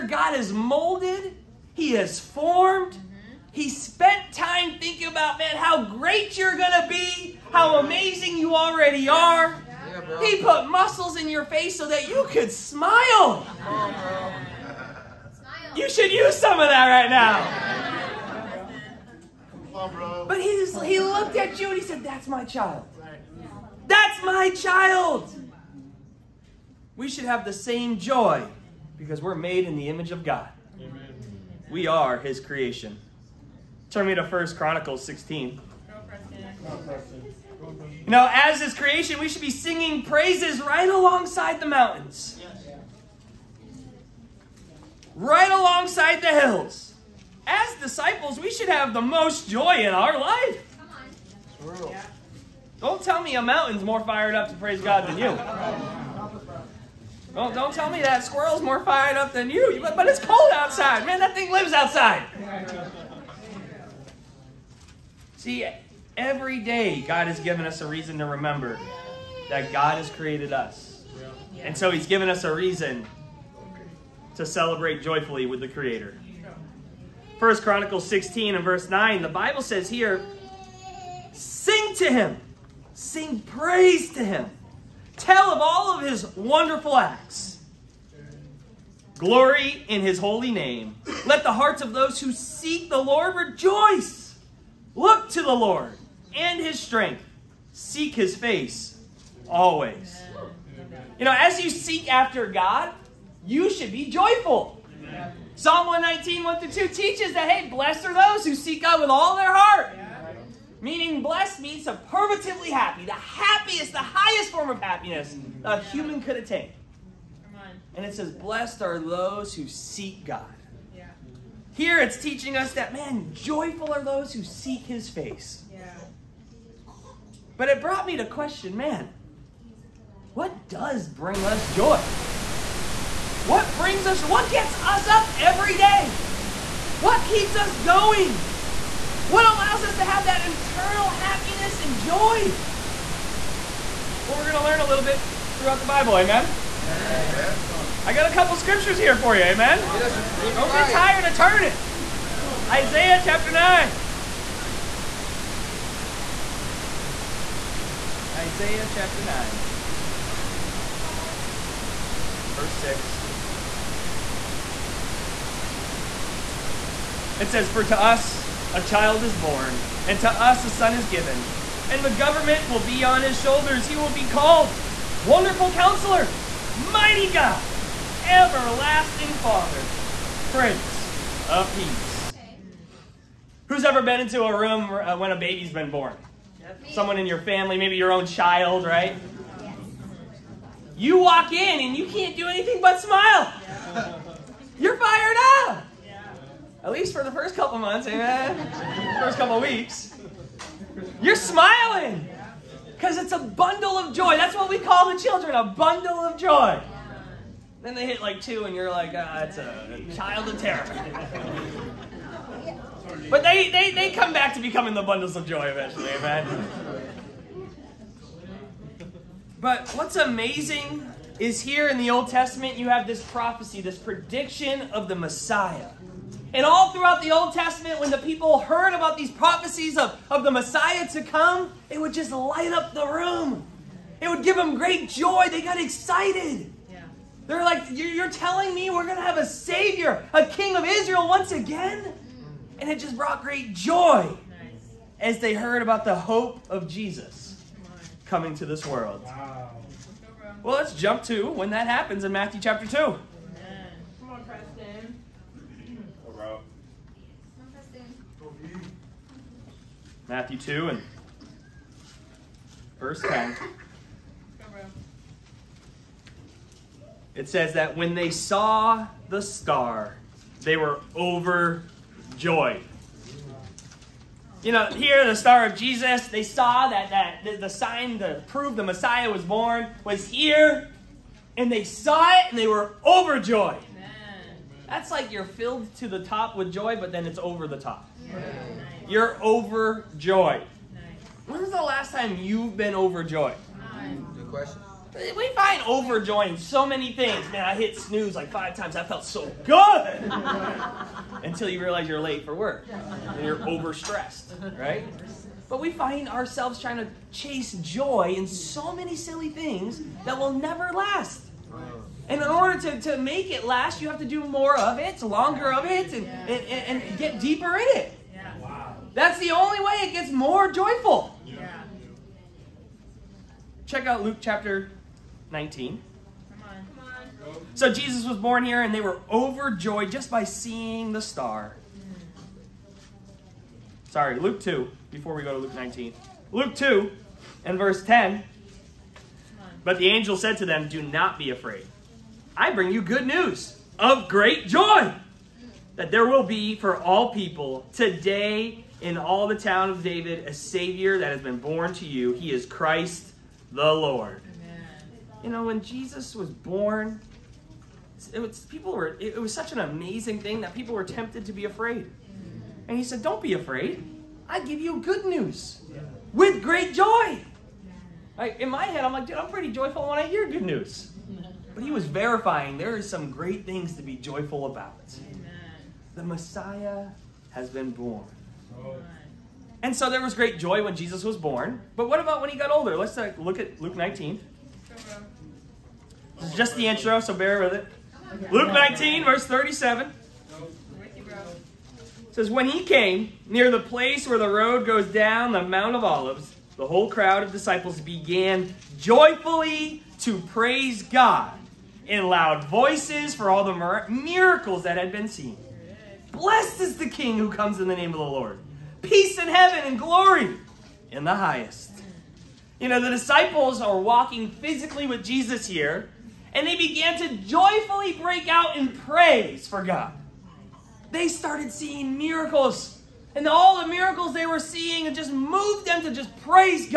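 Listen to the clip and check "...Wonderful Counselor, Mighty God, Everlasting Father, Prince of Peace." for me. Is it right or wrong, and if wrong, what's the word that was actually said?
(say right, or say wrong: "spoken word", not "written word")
right.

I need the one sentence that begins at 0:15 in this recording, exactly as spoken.
You should use some of that right now.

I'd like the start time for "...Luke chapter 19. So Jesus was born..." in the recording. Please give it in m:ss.
5:24.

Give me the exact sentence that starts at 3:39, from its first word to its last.
but what's amazing is here in the Old Testament, you have this prophecy, this prediction of the Messiah.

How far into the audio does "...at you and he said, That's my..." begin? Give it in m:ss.
0:21.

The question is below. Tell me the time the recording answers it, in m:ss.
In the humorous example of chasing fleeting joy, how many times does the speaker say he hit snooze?
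4:58.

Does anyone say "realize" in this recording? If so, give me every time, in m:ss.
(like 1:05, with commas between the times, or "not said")
5:01.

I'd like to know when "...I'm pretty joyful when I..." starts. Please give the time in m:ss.
6:09.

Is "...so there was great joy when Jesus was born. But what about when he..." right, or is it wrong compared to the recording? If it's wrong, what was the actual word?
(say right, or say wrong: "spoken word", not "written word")
right.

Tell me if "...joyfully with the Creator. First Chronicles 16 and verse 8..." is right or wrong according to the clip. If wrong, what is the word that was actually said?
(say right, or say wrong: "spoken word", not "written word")
wrong: "9", not "8".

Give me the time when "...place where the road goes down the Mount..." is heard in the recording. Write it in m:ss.
6:33.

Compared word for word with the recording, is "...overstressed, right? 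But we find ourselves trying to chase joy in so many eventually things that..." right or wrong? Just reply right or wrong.
wrong.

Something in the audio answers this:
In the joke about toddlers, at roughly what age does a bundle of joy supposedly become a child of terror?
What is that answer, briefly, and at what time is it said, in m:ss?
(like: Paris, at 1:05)
2, at 3:28.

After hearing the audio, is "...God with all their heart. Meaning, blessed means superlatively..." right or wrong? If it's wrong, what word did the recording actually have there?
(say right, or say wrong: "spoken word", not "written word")
right.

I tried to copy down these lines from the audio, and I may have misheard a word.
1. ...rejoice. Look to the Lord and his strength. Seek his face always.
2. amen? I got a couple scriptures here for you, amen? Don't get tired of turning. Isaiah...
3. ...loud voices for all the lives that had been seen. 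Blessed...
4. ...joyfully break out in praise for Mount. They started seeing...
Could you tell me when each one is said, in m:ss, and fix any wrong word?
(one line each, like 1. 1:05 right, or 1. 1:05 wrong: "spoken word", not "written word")
1. 1:33 right
2. 2:26 right
3. 6:42 wrong: "miracles", not "lives"
4. 6:57 wrong: "God", not "Mount".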